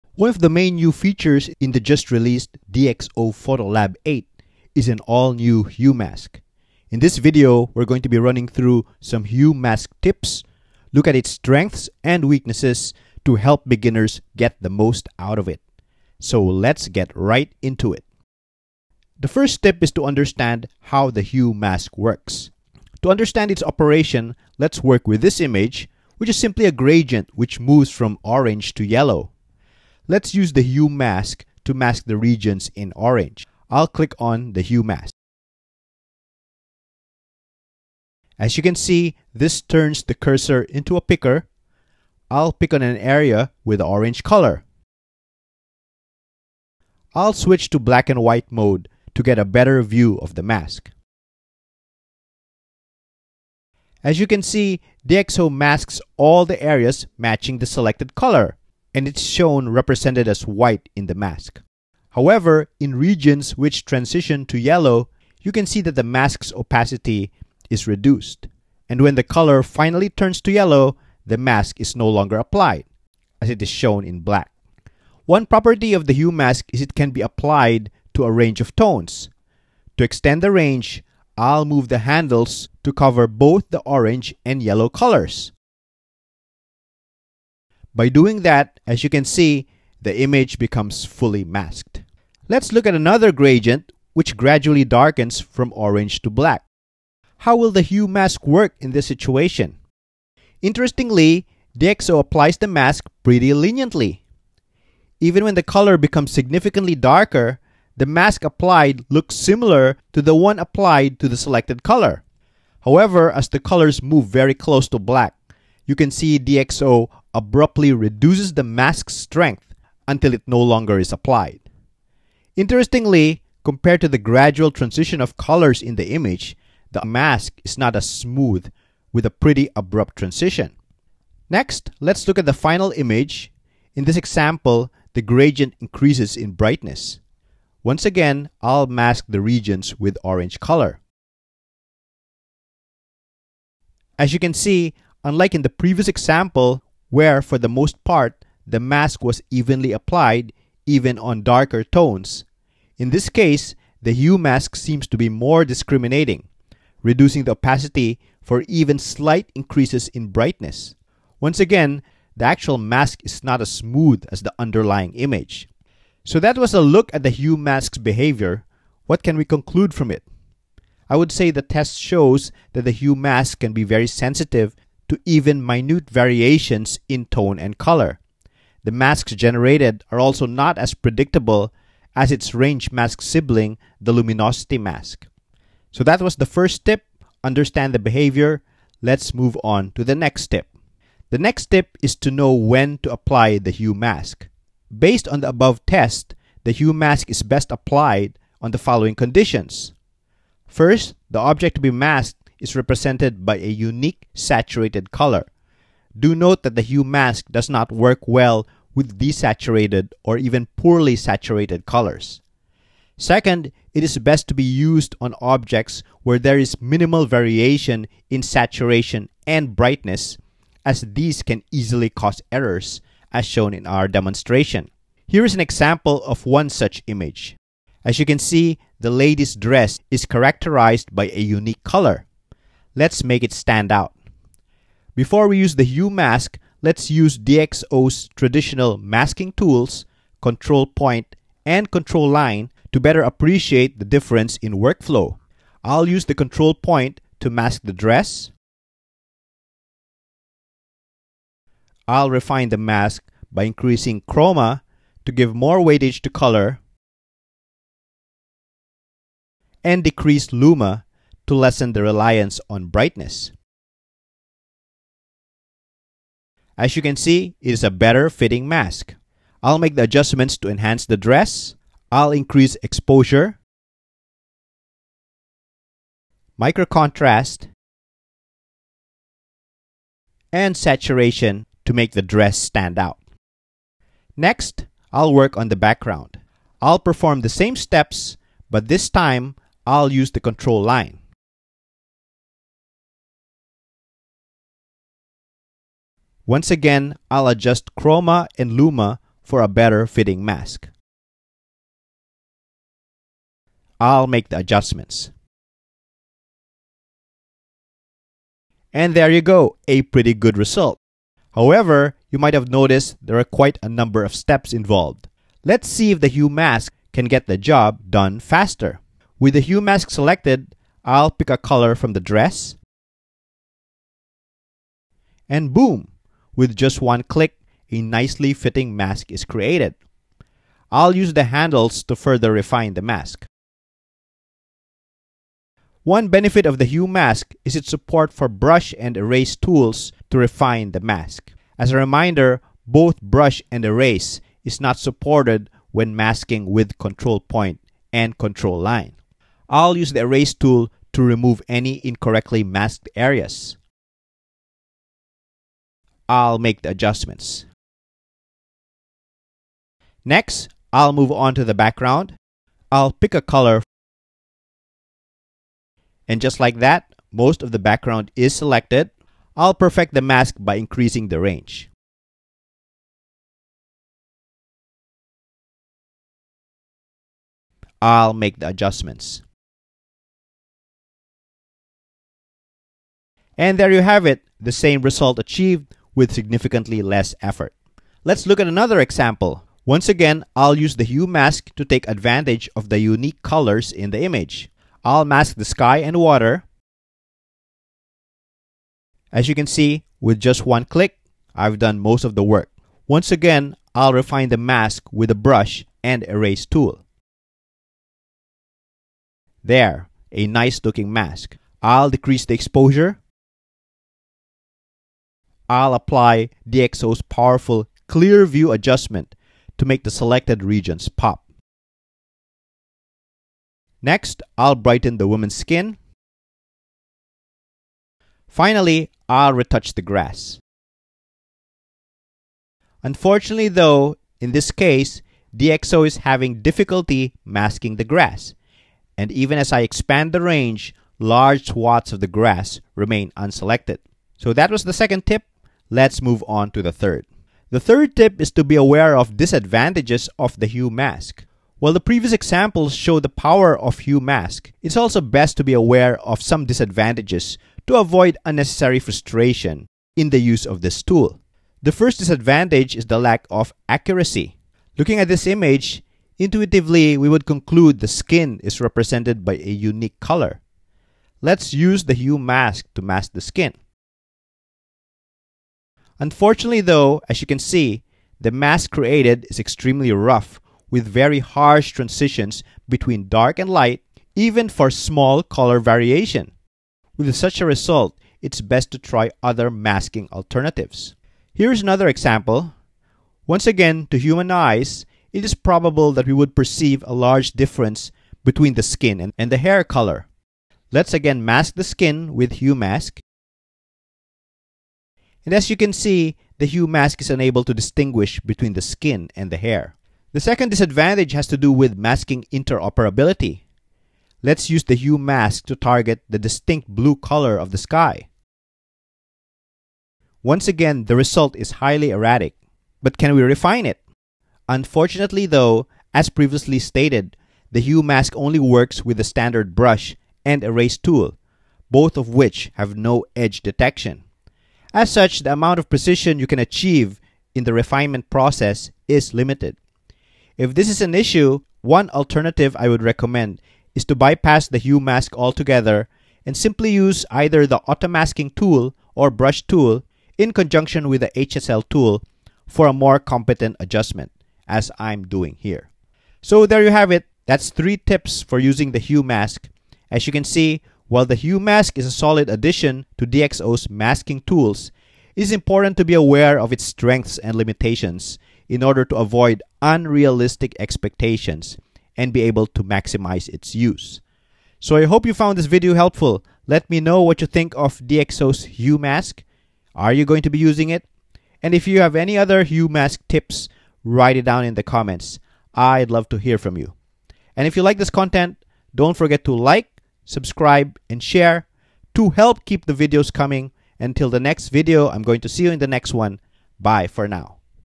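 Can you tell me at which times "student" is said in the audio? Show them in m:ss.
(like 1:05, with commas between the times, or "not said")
not said.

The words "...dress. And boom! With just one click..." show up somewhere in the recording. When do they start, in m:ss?
5:22.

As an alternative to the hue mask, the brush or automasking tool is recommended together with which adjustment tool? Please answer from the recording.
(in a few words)
HSL tool.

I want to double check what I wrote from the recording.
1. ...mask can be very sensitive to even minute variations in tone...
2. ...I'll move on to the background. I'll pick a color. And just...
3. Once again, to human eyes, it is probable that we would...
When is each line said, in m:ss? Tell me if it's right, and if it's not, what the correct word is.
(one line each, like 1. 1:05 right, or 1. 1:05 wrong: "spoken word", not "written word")
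1. 2:53 right
2. 6:00 right
3. 8:13 right.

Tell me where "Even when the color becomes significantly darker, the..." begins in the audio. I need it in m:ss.
1:45.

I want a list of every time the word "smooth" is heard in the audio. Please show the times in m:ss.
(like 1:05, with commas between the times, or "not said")
2:08, 2:43.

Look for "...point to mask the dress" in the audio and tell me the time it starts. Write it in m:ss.
4:06.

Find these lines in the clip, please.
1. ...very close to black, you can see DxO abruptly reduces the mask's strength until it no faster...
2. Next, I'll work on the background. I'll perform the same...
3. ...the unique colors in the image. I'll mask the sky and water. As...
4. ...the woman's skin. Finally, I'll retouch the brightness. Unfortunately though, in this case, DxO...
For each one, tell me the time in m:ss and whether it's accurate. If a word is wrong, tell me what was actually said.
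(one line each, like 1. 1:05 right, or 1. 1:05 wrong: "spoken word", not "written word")
1. 1:54 wrong: "longer", not "faster"
2. 4:44 right
3. 6:32 right
4. 7:05 wrong: "grass", not "brightness".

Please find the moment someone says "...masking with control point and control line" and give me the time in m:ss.
5:46.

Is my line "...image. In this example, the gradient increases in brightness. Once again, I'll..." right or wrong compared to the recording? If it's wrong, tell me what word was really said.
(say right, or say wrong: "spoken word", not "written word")
right.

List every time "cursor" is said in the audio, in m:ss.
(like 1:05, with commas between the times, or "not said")
0:40.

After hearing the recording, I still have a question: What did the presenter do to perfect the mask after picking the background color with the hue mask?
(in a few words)
increasing the range.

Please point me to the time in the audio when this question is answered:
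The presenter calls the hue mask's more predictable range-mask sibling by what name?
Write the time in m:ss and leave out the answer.
3:04.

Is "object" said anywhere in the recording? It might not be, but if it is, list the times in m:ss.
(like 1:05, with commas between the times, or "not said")
3:21, 3:35.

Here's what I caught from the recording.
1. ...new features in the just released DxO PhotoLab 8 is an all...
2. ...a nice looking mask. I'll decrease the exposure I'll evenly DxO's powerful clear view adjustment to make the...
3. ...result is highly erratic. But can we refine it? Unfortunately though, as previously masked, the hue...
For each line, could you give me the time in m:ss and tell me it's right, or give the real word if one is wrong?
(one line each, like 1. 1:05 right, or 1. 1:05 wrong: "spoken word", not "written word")
1. 0:00 right
2. 6:50 wrong: "apply", not "evenly"
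3. 8:41 wrong: "stated", not "masked".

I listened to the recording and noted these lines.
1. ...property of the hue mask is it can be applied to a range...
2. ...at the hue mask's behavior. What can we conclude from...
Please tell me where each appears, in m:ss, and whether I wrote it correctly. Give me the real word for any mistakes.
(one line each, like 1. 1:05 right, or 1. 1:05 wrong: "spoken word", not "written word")
1. 1:15 right
2. 2:47 right.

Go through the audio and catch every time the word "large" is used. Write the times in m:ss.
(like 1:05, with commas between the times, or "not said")
7:21, 8:17.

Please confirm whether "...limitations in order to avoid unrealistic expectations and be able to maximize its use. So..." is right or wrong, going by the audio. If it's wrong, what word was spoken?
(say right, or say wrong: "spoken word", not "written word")
right.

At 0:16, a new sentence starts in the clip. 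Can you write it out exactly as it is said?
So let's get right into it.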